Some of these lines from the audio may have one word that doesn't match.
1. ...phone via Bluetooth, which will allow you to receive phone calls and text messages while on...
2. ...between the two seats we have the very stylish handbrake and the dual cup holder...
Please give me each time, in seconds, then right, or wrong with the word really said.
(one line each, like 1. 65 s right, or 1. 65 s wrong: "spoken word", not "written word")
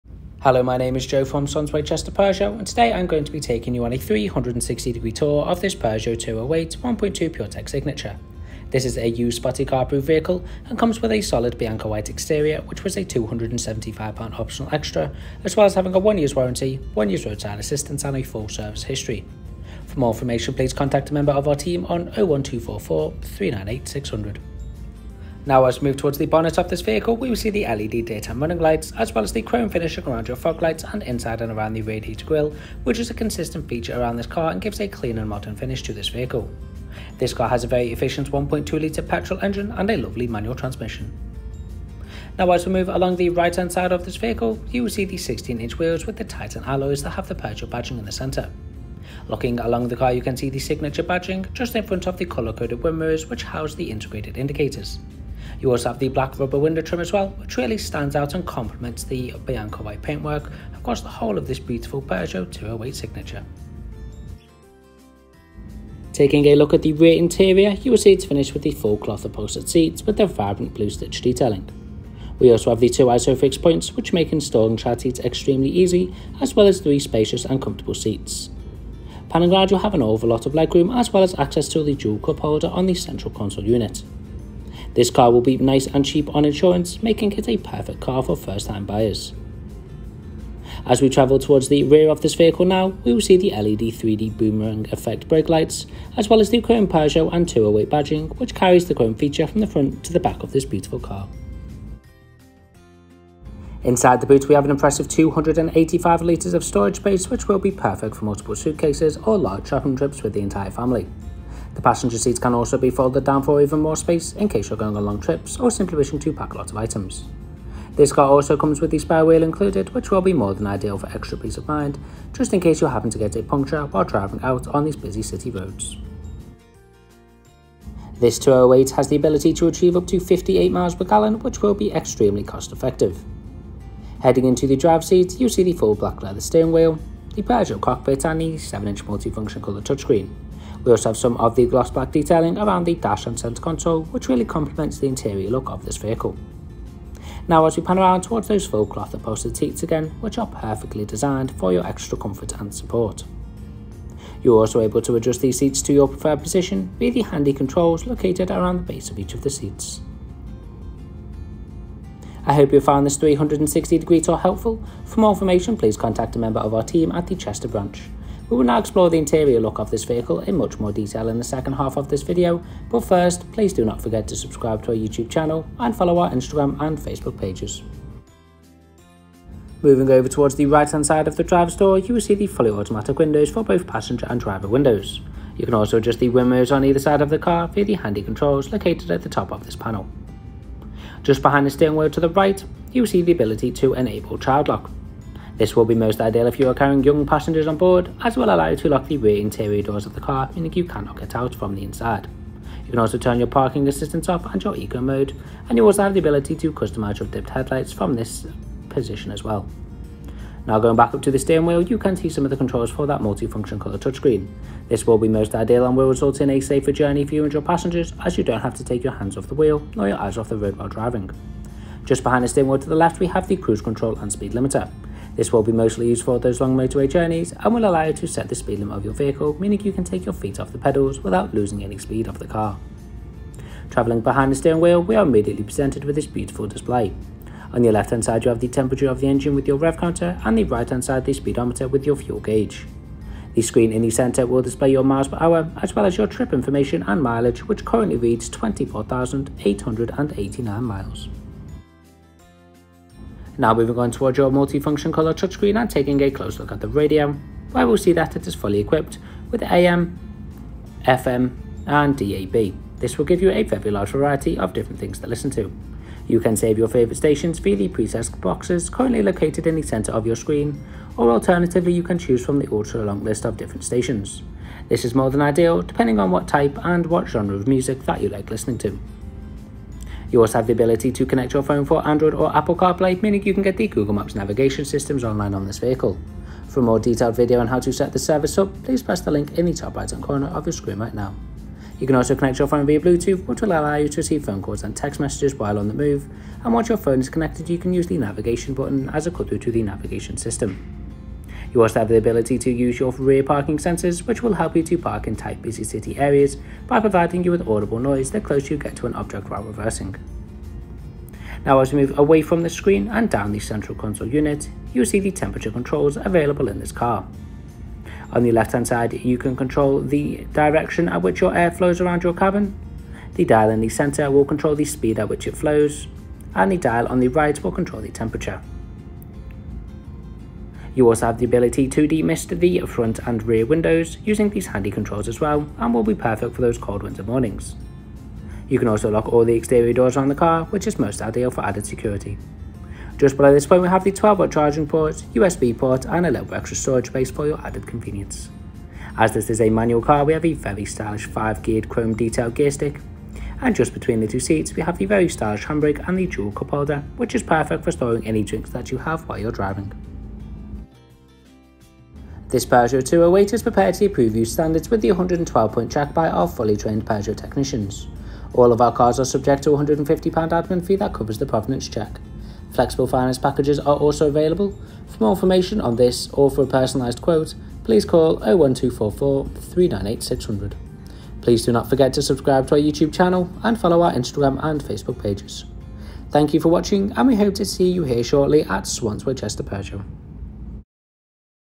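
1. 292 s right
2. 353 s right.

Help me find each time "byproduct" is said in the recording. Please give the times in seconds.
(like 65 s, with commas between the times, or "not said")
not said.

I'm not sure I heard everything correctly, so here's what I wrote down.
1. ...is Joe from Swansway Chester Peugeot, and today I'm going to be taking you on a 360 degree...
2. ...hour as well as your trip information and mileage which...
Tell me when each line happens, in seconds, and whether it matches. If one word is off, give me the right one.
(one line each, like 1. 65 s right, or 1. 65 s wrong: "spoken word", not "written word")
1. 0 s right
2. 245 s right.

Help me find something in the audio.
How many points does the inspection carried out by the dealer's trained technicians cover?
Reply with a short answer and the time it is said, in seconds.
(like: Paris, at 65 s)
112, at 365 s.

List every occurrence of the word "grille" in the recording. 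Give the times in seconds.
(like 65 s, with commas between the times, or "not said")
32 s.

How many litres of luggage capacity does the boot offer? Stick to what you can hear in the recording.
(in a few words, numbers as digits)
285 litres.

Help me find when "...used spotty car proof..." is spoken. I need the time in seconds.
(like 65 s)
9 s.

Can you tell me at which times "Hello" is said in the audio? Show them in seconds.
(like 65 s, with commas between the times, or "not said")
0 s.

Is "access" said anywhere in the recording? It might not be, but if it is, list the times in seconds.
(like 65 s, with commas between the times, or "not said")
81 s.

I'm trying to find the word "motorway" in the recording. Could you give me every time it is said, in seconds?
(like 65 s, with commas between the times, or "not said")
226 s.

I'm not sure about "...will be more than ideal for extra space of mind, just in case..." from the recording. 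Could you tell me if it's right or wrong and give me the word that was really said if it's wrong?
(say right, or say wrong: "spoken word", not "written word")
wrong: "peace", not "space".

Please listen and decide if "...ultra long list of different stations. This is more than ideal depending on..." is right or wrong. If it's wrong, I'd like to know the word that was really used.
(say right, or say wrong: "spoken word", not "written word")
right.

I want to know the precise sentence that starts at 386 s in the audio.
Thank you for watching and we hope to see you here shortly at Swansway Chester Peugeot.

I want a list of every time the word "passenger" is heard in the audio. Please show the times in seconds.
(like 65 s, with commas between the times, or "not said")
111 s, 183 s, 197 s, 217 s.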